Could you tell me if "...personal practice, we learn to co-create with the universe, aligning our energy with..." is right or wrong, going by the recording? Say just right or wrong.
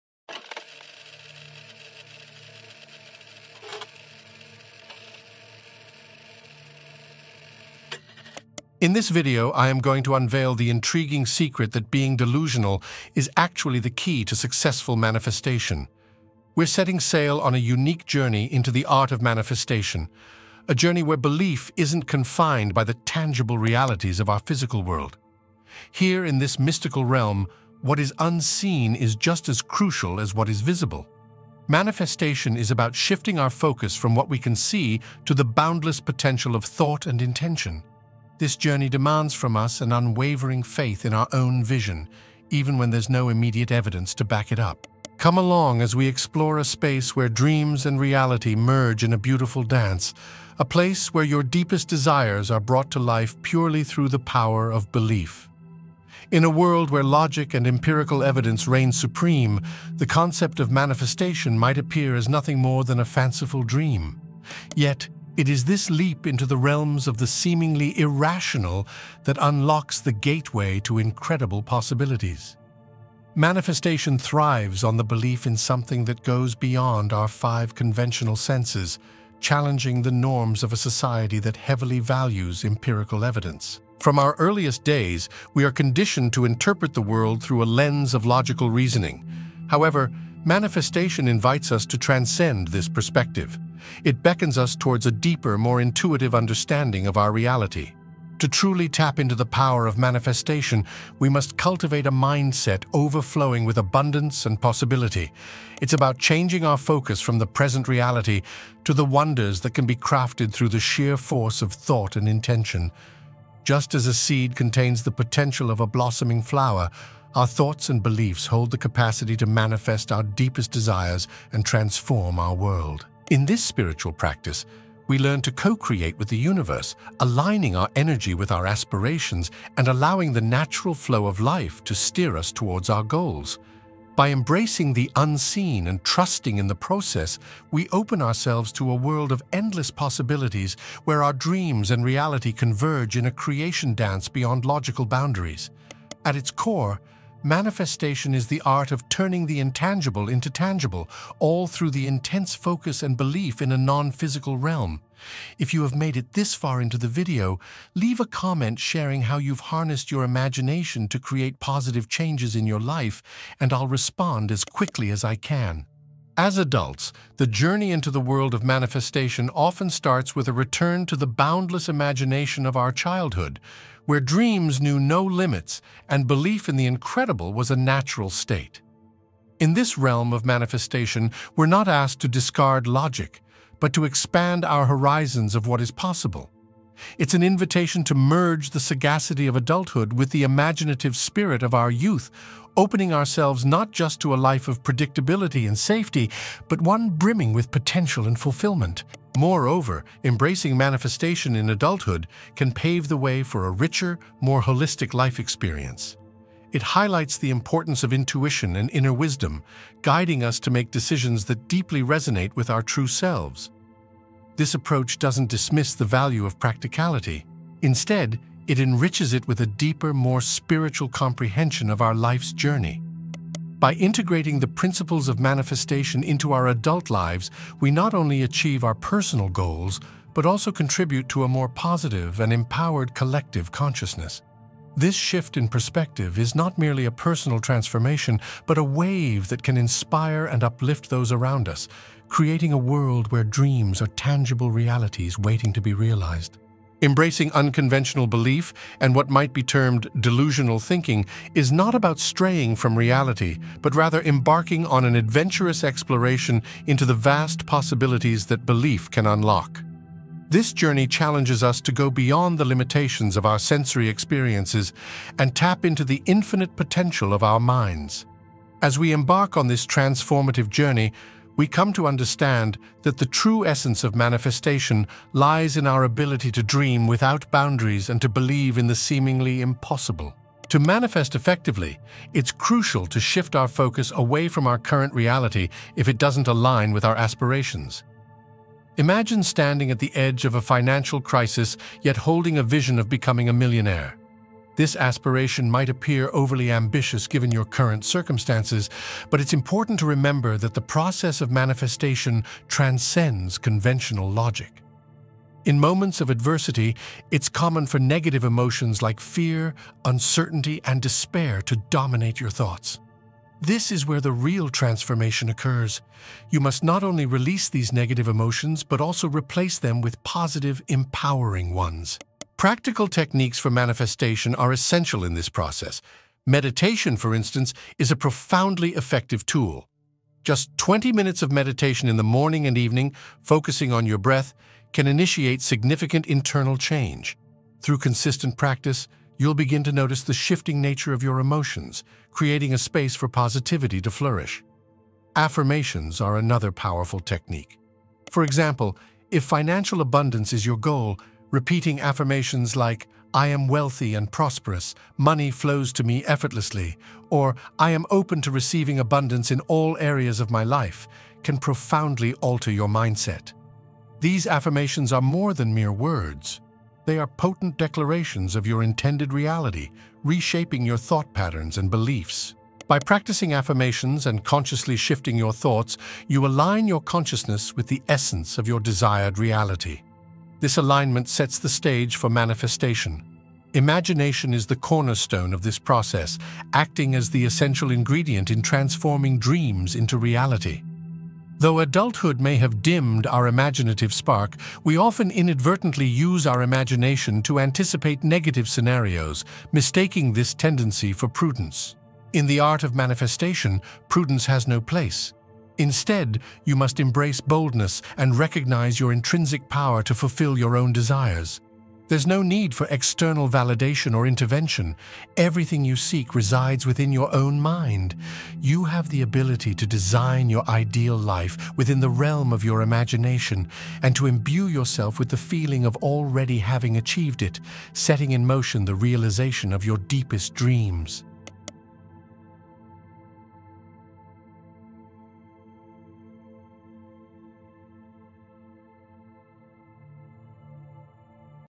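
wrong.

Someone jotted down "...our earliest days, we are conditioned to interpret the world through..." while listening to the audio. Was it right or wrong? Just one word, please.
right.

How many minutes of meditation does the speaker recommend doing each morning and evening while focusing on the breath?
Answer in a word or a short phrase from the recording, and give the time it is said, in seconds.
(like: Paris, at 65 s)
20, at 330 s.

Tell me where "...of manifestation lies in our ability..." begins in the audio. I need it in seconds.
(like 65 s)
274 s.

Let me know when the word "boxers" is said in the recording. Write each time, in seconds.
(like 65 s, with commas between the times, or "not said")
not said.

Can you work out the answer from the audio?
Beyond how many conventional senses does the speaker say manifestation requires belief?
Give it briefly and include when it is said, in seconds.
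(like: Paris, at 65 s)
5, at 77 s.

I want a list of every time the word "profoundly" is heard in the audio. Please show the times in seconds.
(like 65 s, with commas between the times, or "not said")
328 s, 361 s.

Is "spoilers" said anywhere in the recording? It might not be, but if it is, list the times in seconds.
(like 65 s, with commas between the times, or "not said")
not said.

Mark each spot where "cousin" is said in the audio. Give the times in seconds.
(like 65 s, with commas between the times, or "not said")
not said.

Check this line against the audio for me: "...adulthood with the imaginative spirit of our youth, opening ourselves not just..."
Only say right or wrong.
right.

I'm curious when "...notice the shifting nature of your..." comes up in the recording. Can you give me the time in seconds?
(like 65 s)
339 s.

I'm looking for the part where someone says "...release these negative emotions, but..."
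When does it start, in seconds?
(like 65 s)
317 s.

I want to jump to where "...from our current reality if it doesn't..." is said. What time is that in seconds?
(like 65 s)
284 s.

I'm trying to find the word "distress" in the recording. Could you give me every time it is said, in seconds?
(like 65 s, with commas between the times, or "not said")
not said.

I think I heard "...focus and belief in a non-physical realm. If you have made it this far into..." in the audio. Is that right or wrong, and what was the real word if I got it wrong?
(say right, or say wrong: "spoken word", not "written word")
right.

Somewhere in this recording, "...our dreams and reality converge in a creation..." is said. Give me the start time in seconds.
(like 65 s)
141 s.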